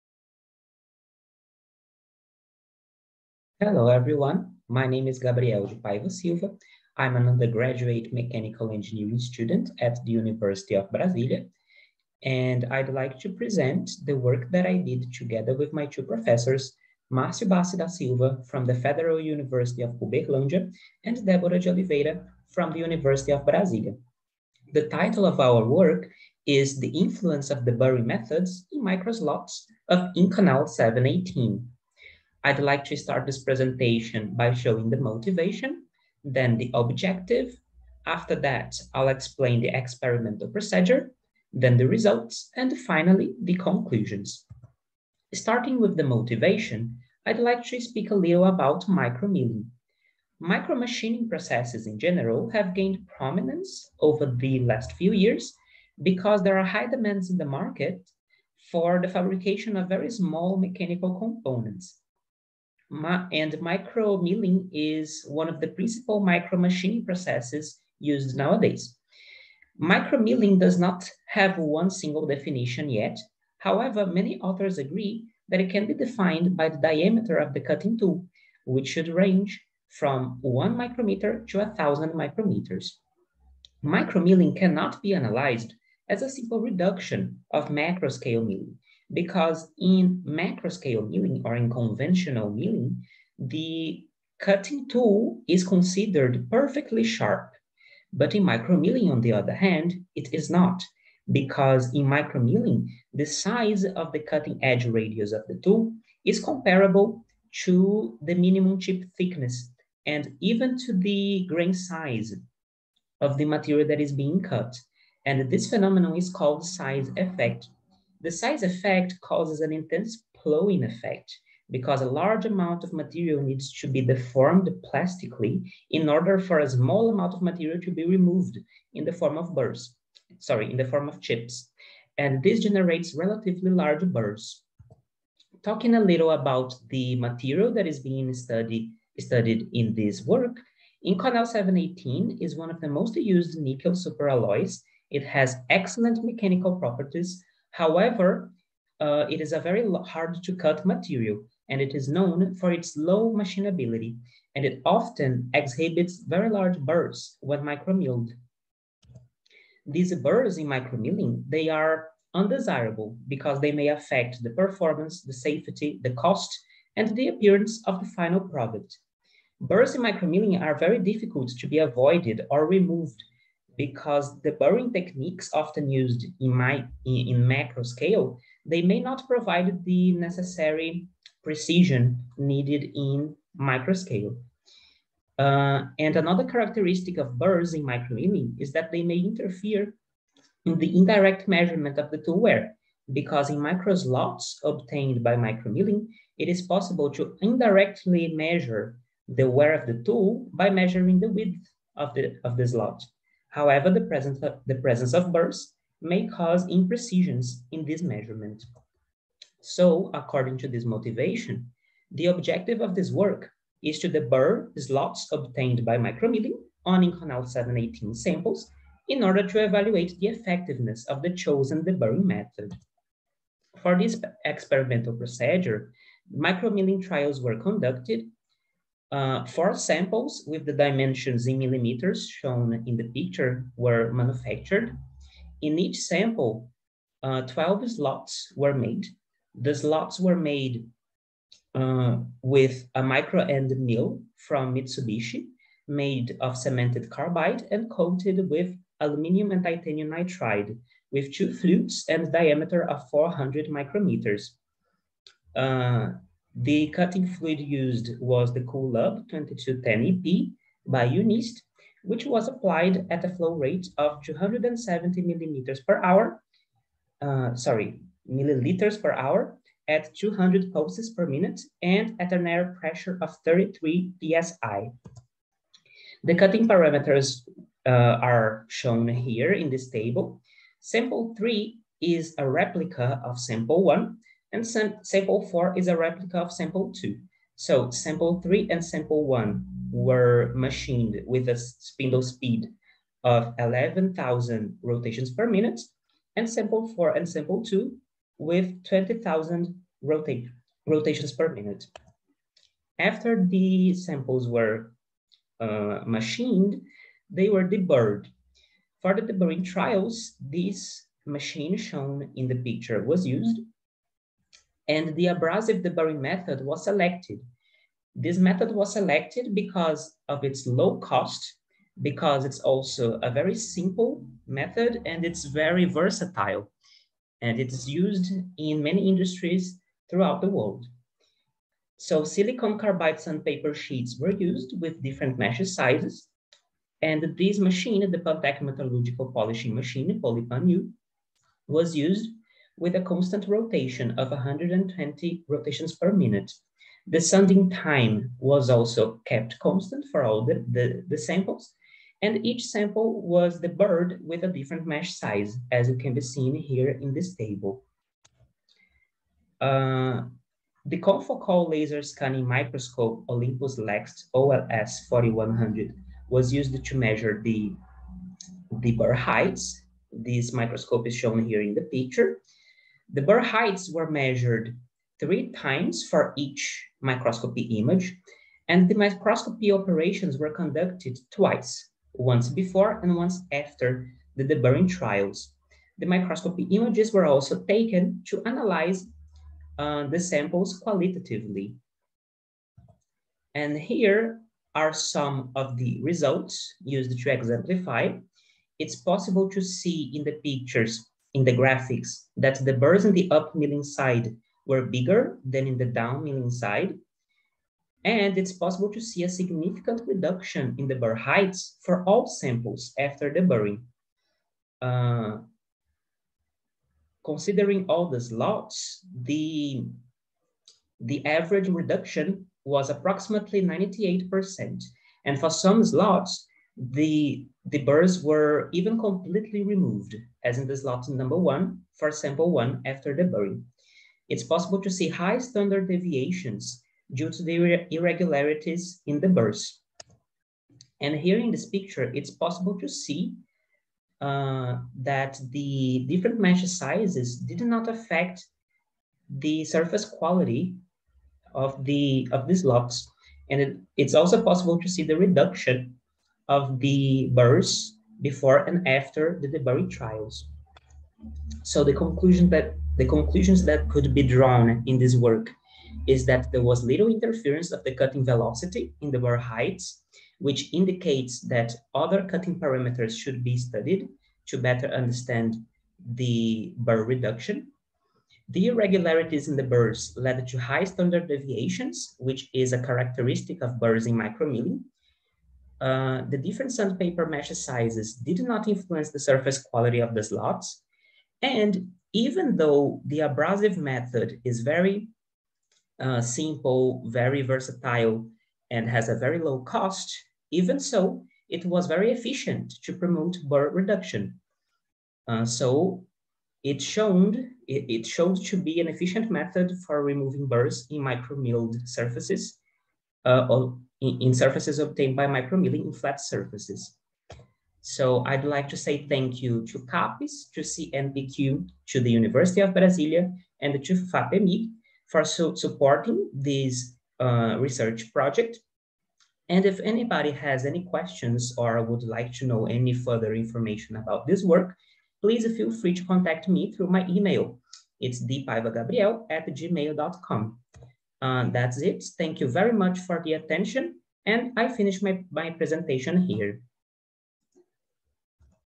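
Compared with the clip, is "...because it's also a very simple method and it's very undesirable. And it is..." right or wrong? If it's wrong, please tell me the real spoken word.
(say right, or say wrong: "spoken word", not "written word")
wrong: "versatile", not "undesirable".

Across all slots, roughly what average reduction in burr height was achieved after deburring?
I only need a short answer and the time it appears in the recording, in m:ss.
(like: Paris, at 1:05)
98%, at 7:03.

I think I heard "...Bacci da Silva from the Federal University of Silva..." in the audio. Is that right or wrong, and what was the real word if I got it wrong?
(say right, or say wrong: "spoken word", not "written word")
wrong: "Uberlândia", not "Silva".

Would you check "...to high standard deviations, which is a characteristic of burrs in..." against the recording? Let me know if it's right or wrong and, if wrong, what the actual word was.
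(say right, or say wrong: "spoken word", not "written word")
right.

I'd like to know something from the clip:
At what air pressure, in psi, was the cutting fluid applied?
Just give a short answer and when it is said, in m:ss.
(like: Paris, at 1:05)
33 psi, at 4:33.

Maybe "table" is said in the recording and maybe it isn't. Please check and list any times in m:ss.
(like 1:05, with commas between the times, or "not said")
4:39, 5:57.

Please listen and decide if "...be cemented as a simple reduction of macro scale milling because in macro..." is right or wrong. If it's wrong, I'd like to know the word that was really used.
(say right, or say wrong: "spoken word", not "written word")
wrong: "analyzed", not "cemented".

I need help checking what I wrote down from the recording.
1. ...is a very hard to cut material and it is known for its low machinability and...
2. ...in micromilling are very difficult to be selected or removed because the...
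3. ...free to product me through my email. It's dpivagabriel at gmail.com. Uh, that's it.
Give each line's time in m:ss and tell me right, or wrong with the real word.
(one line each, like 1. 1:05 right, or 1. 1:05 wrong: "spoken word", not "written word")
1. 2:29 right
2. 2:49 wrong: "avoided", not "selected"
3. 8:55 wrong: "contact", not "product".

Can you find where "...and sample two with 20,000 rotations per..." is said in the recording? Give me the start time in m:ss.
4:57.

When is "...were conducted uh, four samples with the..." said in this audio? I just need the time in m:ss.
3:47.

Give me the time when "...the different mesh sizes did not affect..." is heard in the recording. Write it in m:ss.
7:25.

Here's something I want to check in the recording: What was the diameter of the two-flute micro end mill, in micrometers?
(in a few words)
400.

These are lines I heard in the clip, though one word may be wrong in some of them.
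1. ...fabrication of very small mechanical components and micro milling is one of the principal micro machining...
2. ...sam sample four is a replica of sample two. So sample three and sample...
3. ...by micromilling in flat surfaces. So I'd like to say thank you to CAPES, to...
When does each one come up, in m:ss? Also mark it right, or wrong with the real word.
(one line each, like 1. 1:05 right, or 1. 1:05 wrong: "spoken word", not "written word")
1. 0:59 right
2. 4:44 right
3. 8:35 right.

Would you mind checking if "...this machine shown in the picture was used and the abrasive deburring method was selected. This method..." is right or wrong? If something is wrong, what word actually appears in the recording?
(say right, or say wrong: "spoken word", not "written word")
right.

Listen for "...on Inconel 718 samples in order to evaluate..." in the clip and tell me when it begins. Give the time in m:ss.
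3:36.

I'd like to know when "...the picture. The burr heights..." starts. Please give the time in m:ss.
6:11.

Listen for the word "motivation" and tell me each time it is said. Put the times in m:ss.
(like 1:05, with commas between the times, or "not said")
0:34, 0:46, 3:30.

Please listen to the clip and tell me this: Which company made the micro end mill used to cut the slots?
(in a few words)
Mitsubishi.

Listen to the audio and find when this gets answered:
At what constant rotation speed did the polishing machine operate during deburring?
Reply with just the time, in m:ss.
5:44.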